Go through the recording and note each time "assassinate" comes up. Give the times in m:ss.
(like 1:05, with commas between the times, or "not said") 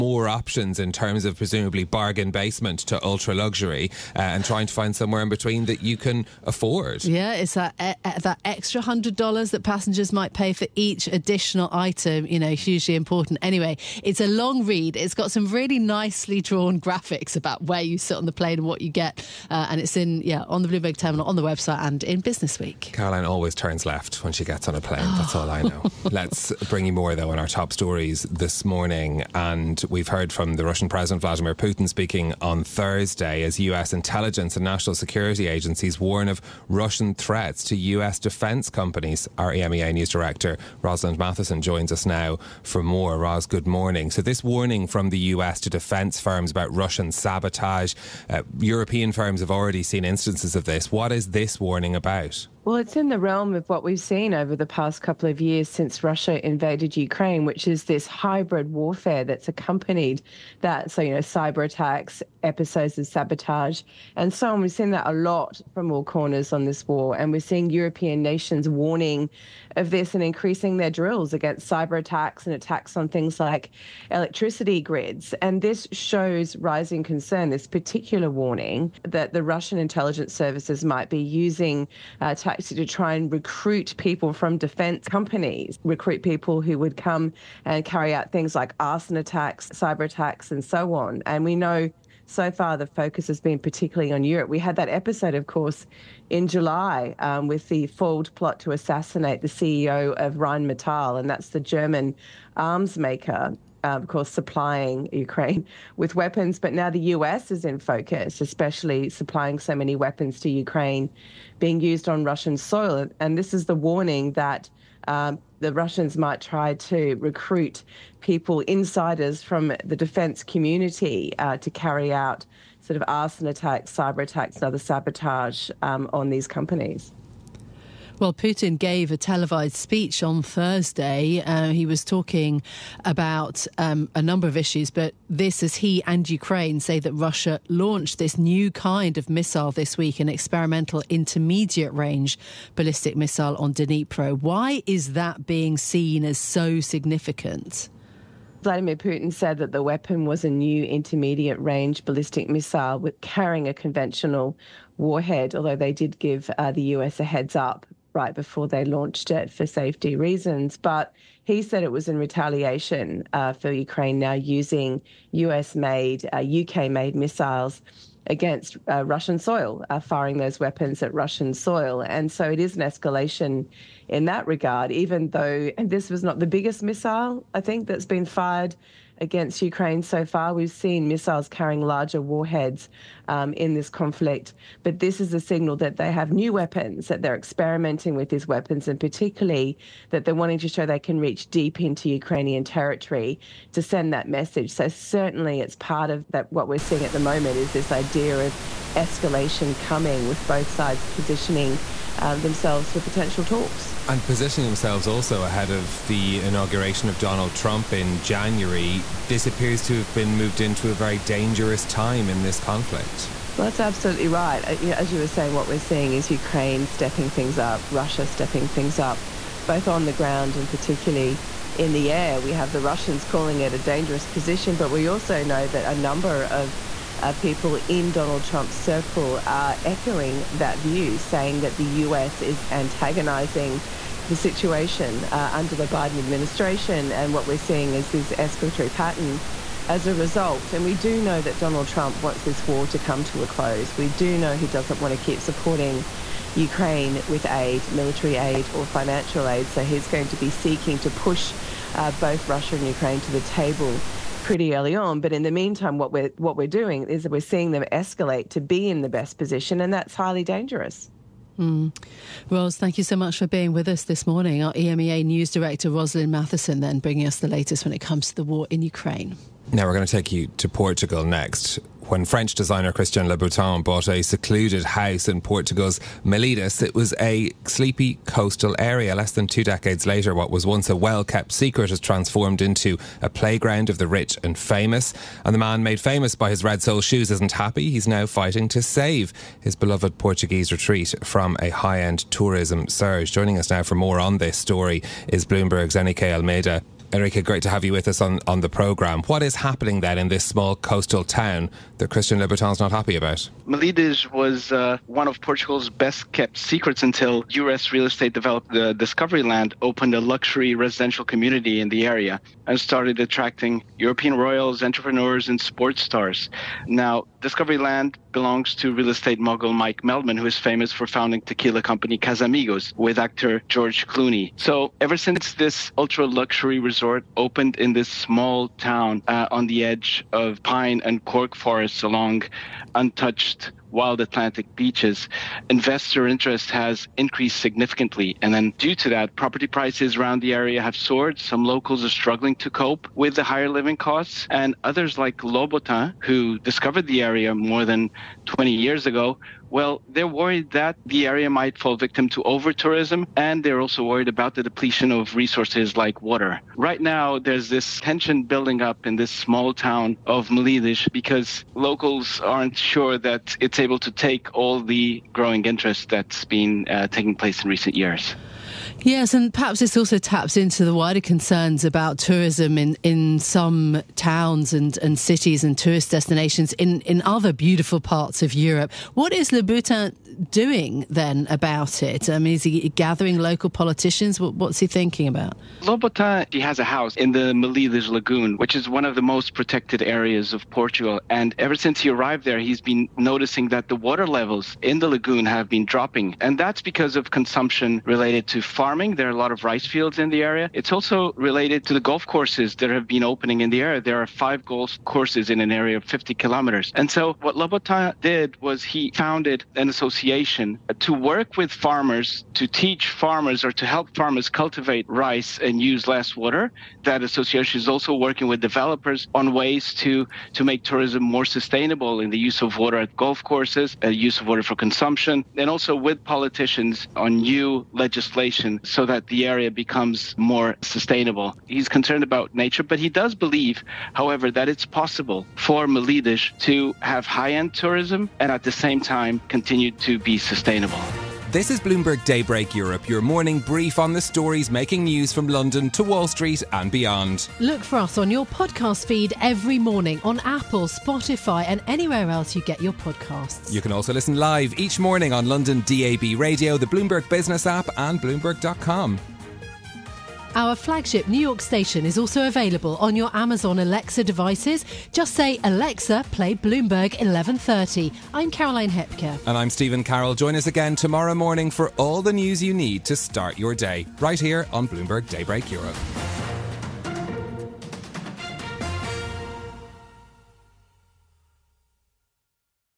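1:38.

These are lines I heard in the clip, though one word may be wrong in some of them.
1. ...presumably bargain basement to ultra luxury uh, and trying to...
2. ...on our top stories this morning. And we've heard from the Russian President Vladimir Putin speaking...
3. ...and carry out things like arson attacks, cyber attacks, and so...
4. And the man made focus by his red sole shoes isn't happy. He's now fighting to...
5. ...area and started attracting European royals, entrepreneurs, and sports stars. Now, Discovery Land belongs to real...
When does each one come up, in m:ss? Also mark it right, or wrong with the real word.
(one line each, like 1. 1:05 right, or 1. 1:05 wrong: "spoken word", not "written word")
1. 0:01 right
2. 0:27 right
3. 1:27 right
4. 4:45 wrong: "famous", not "focus"
5. 5:12 right.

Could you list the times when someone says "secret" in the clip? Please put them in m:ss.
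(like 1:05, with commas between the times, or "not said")
4:41, 5:06.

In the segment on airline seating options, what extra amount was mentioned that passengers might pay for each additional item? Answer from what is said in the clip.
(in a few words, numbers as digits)
$100.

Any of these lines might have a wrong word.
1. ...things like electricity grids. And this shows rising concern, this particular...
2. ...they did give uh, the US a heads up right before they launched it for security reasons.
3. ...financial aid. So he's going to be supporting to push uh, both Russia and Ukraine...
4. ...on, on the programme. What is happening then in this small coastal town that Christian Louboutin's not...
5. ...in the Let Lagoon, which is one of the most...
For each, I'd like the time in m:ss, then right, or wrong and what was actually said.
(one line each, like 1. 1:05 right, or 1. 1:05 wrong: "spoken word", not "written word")
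1. 1:13 right
2. 2:35 wrong: "safety", not "security"
3. 4:08 wrong: "seeking", not "supporting"
4. 4:58 right
5. 6:27 wrong: "Melides", not "Let".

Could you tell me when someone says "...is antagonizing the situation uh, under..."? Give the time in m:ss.
3:52.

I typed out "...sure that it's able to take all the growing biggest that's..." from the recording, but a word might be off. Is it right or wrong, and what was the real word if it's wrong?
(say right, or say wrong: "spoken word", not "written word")
wrong: "interest", not "biggest".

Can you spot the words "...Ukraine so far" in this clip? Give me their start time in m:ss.
2:59.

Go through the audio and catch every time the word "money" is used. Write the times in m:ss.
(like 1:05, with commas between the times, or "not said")
not said.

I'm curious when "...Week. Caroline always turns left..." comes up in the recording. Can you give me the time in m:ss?
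0:22.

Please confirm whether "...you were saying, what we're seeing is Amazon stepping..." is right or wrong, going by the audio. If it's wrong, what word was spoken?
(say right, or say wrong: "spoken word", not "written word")
wrong: "Ukraine", not "Amazon".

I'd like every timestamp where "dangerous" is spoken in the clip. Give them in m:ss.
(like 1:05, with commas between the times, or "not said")
3:31, 3:43, 4:20.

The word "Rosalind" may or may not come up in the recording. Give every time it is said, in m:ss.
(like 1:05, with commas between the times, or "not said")
0:40, 4:25.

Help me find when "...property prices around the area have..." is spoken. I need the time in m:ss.
5:39.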